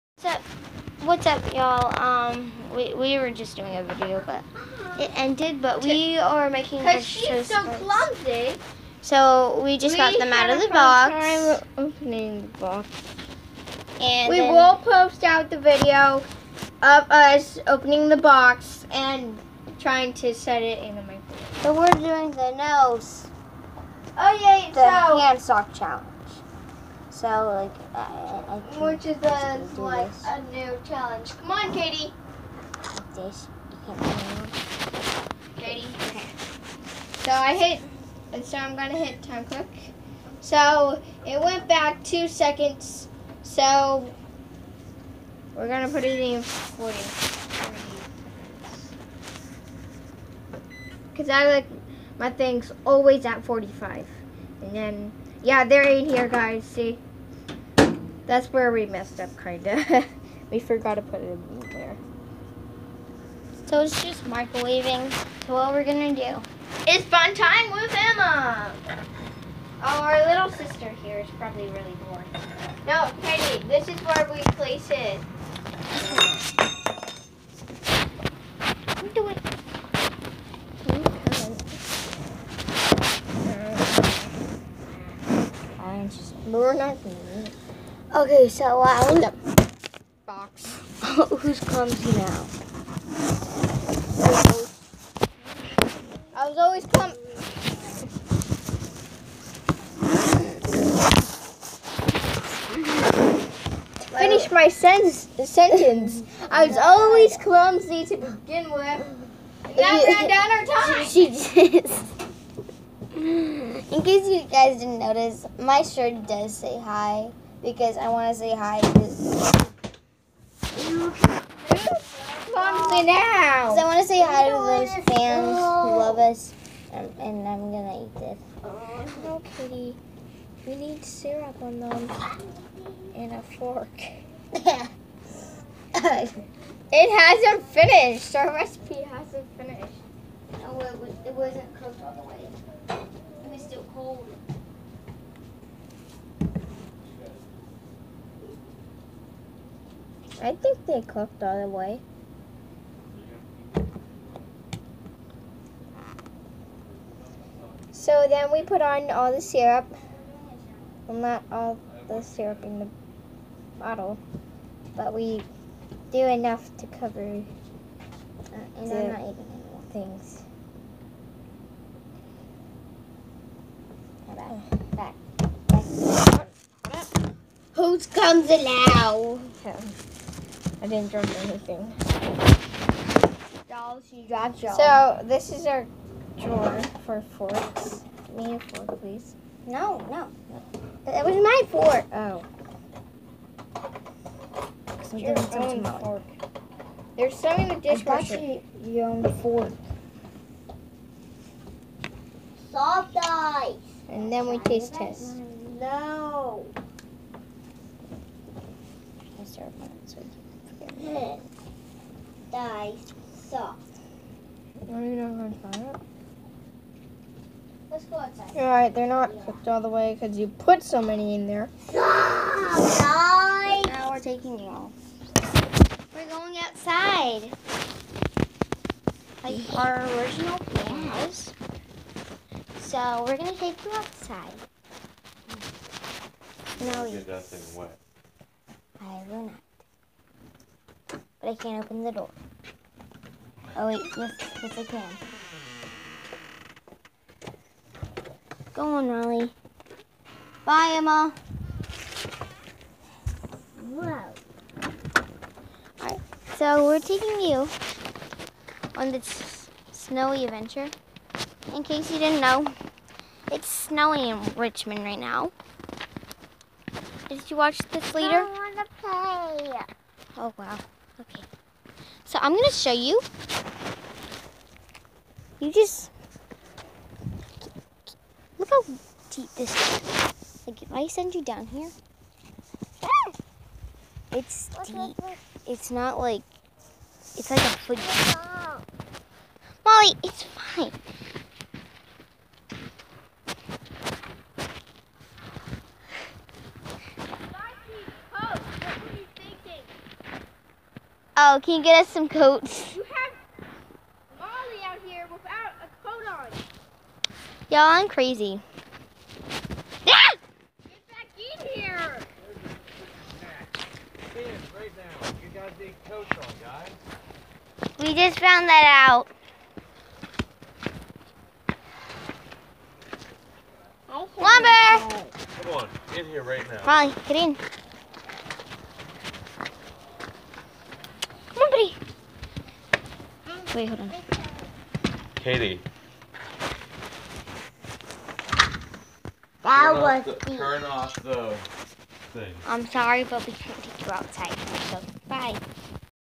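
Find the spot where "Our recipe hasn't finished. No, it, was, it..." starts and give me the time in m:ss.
2:18.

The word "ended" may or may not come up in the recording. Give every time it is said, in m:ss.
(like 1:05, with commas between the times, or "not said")
0:05.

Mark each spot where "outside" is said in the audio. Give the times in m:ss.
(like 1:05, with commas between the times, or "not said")
3:38, 3:46, 3:53, 5:44.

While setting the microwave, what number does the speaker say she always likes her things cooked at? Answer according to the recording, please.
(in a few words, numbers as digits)
45.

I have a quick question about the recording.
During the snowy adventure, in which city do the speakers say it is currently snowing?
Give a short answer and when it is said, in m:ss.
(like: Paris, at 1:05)
Richmond, at 4:24.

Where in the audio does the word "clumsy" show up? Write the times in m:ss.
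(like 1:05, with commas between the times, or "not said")
0:07, 1:31, 1:36, 1:47.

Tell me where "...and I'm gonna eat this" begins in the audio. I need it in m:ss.
2:07.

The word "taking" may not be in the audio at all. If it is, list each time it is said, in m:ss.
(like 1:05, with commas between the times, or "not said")
3:44, 4:16.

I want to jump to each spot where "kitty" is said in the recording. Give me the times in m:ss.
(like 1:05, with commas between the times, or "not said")
2:09.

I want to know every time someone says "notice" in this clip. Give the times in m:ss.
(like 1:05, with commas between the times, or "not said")
1:54.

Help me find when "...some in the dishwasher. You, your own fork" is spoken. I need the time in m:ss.
3:17.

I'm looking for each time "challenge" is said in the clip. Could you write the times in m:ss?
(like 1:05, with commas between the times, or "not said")
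0:25, 0:30.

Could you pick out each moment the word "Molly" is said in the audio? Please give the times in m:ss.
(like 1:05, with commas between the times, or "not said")
4:49, 5:04, 5:26.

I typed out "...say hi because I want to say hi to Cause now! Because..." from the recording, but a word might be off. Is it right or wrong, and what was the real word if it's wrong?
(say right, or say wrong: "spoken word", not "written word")
wrong: "Mommy", not "Cause".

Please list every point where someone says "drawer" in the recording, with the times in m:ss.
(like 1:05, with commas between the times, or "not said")
3:06.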